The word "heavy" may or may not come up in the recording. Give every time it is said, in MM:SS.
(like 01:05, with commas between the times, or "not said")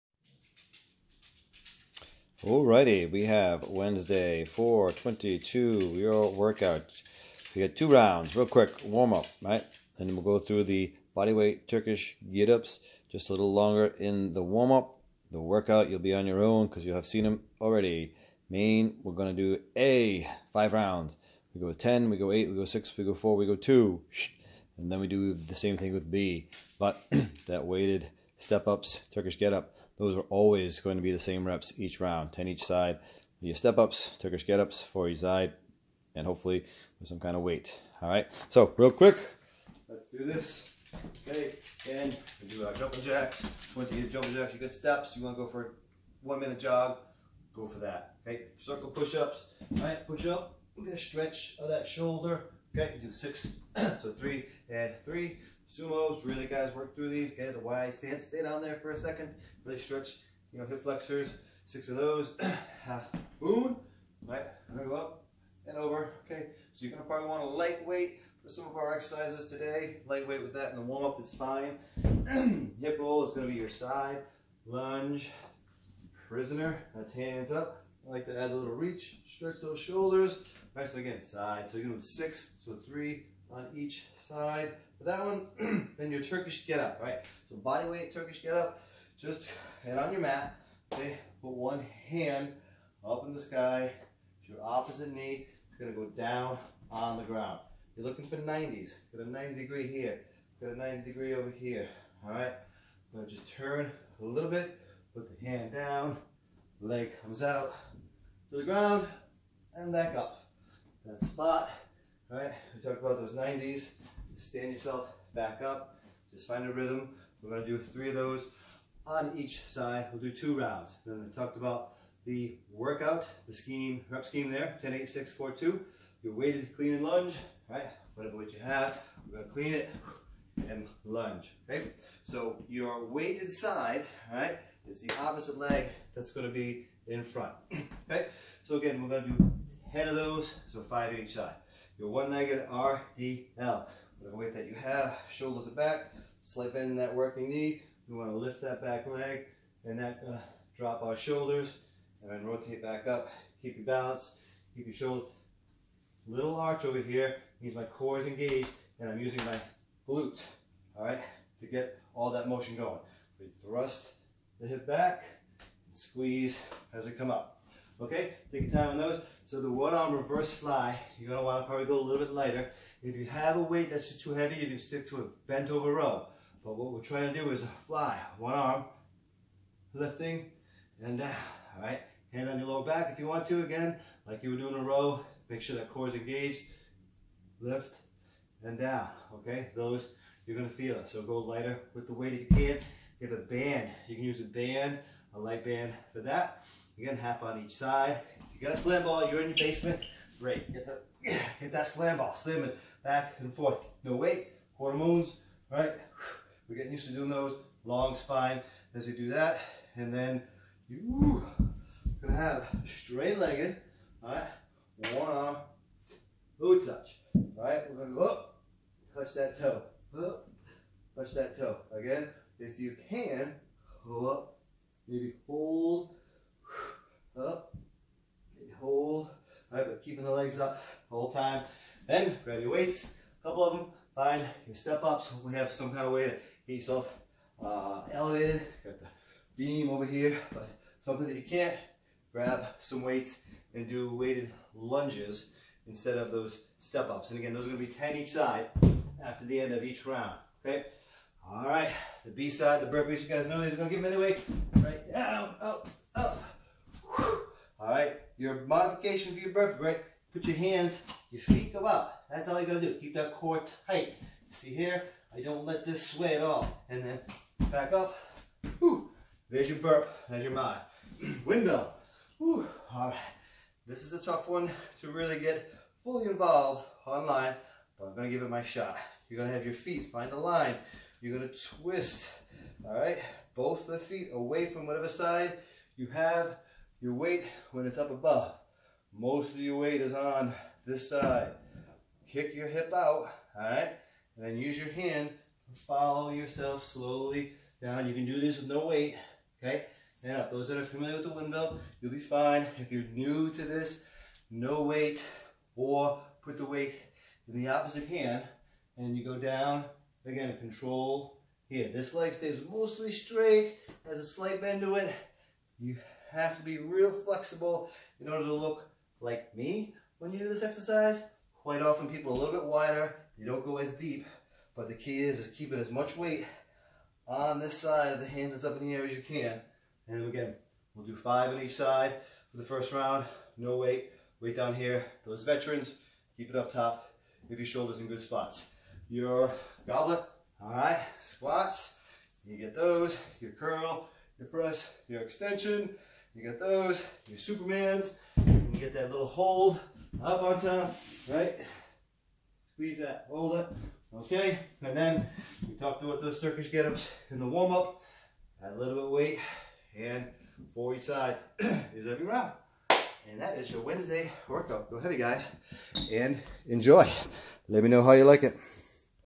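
02:54, 06:04.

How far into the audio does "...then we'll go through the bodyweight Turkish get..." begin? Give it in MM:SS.
00:10.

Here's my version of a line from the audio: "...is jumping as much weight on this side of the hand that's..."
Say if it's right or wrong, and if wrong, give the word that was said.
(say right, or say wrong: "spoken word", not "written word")
wrong: "keeping", not "jumping".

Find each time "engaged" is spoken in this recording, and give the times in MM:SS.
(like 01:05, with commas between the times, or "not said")
02:38, 03:06.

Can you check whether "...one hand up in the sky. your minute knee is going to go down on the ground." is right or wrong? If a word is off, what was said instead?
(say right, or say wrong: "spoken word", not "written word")
wrong: "opposite", not "minute".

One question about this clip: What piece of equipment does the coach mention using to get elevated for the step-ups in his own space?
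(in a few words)
the beam.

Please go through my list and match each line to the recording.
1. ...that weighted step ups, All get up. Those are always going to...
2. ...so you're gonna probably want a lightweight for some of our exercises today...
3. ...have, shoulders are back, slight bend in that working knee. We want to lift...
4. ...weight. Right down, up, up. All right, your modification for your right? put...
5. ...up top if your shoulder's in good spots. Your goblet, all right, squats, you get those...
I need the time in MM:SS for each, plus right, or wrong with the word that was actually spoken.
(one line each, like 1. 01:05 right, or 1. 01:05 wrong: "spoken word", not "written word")
1. 00:27 wrong: "Turkish", not "All"
2. 01:06 right
3. 02:24 right
4. 04:14 right
5. 05:36 right.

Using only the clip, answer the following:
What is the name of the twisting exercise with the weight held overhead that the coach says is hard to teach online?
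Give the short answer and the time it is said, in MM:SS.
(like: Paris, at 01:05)
windmill, at 05:01.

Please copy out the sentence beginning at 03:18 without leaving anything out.
You got a slam ball, you're in your basement.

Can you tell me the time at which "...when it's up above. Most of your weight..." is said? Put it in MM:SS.
04:47.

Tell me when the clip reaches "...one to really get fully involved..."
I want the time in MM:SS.
04:34.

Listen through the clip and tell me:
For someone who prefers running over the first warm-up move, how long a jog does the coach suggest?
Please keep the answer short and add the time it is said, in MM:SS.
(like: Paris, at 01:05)
one minute, at 00:46.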